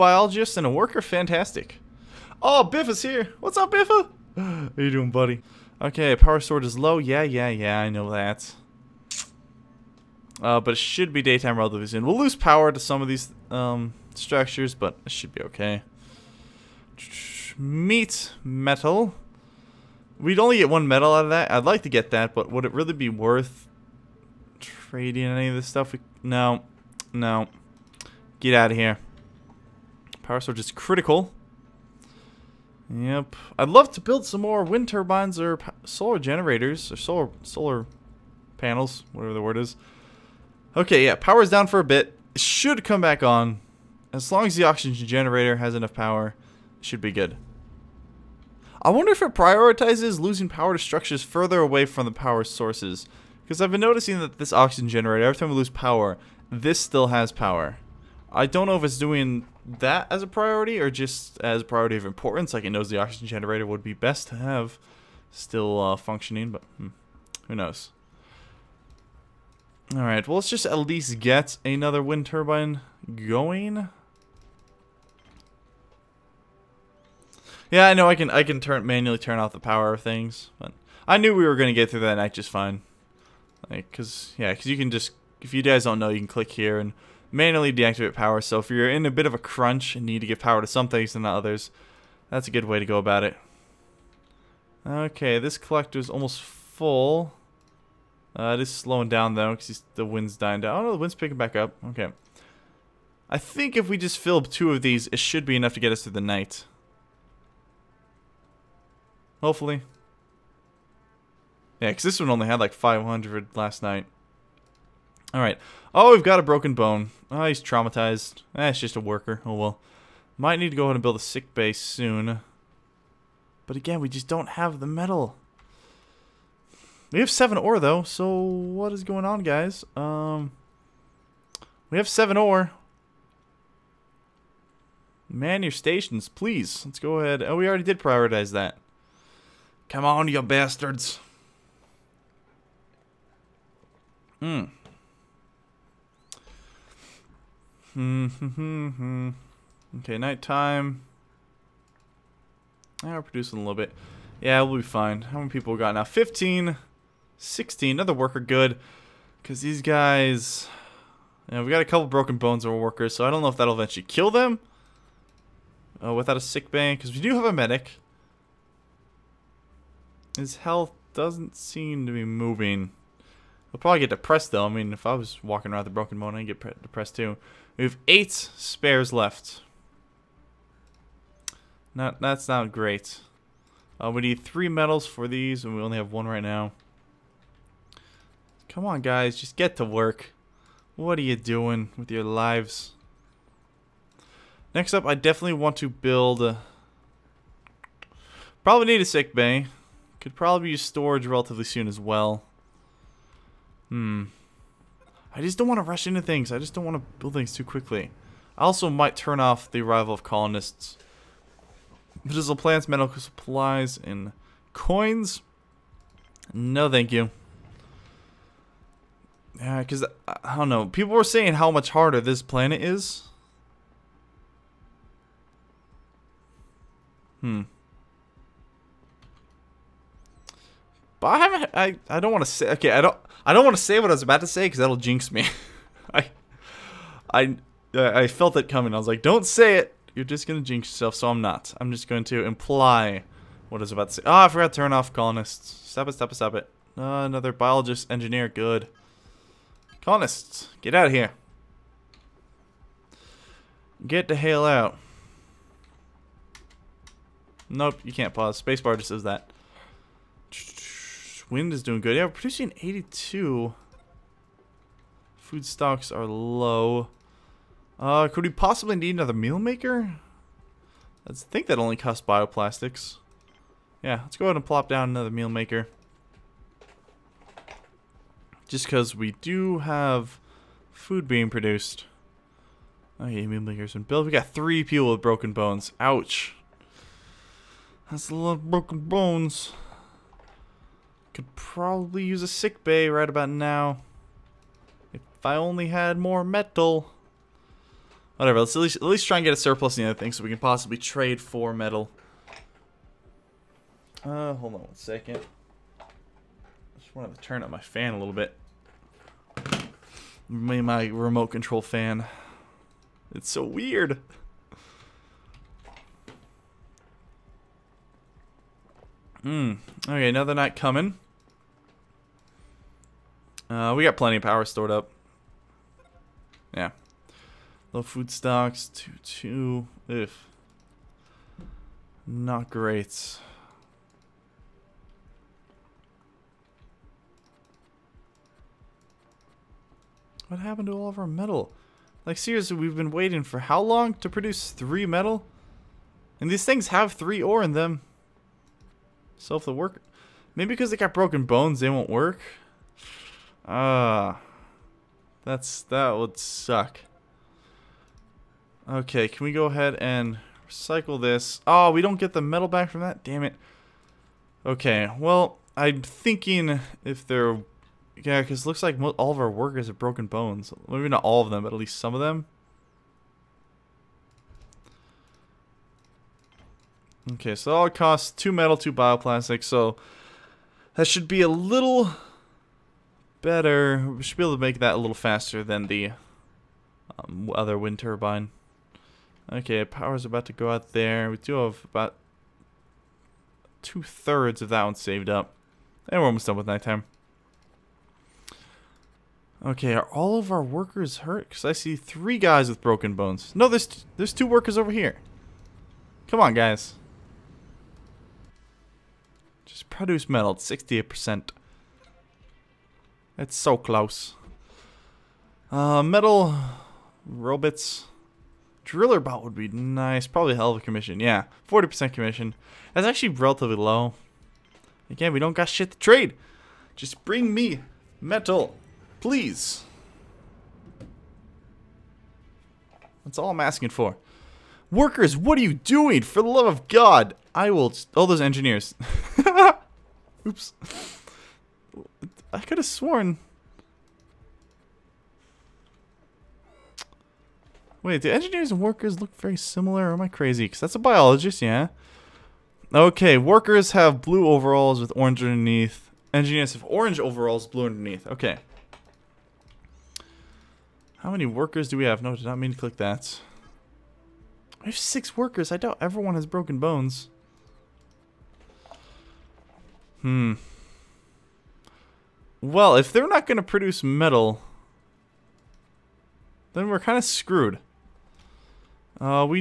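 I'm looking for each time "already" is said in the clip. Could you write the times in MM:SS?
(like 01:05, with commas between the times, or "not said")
02:17.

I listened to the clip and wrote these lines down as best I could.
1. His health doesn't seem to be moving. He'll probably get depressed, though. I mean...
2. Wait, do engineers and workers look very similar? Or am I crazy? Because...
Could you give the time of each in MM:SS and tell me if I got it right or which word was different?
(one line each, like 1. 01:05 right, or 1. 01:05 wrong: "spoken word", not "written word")
1. 02:50 right
2. 07:28 right.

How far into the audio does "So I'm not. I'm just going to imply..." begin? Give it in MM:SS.
04:01.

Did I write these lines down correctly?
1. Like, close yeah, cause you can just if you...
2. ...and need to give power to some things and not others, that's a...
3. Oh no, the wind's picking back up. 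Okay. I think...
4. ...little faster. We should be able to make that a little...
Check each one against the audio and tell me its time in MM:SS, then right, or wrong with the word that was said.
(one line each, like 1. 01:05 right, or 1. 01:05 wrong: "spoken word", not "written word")
1. 01:23 wrong: "cause", not "close"
2. 01:29 right
3. 01:40 right
4. 06:21 wrong: "better", not "faster".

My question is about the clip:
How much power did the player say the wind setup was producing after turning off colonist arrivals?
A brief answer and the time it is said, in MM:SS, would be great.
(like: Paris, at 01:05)
82, at 04:22.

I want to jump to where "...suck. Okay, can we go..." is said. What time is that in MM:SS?
05:56.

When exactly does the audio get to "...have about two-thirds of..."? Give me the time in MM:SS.
06:31.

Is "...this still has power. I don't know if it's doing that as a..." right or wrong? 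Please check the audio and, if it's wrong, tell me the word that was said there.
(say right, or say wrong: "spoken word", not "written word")
right.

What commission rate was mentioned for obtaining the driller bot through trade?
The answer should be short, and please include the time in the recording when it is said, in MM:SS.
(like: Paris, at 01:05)
40%, at 07:01.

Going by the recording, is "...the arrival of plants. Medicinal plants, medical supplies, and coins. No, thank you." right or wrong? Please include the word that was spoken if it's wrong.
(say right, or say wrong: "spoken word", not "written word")
wrong: "colonists", not "plants".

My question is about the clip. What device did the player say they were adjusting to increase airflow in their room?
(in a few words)
remote control fan.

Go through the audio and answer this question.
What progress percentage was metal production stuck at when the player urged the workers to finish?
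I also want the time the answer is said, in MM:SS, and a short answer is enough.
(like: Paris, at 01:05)
68%, at 06:50.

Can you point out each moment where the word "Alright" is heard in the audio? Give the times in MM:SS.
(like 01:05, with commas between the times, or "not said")
01:09, 01:55.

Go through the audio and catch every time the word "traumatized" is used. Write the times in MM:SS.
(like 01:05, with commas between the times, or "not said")
01:57.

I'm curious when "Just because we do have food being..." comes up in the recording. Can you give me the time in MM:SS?
04:38.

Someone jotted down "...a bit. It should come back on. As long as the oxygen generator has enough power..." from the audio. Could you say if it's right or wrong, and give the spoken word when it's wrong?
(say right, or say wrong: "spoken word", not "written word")
right.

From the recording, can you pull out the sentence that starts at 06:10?
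Maybe not all of them, but at least some of them.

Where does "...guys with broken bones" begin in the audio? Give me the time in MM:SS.
06:42.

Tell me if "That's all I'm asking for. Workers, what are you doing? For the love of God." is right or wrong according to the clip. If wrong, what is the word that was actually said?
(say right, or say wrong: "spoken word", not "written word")
right.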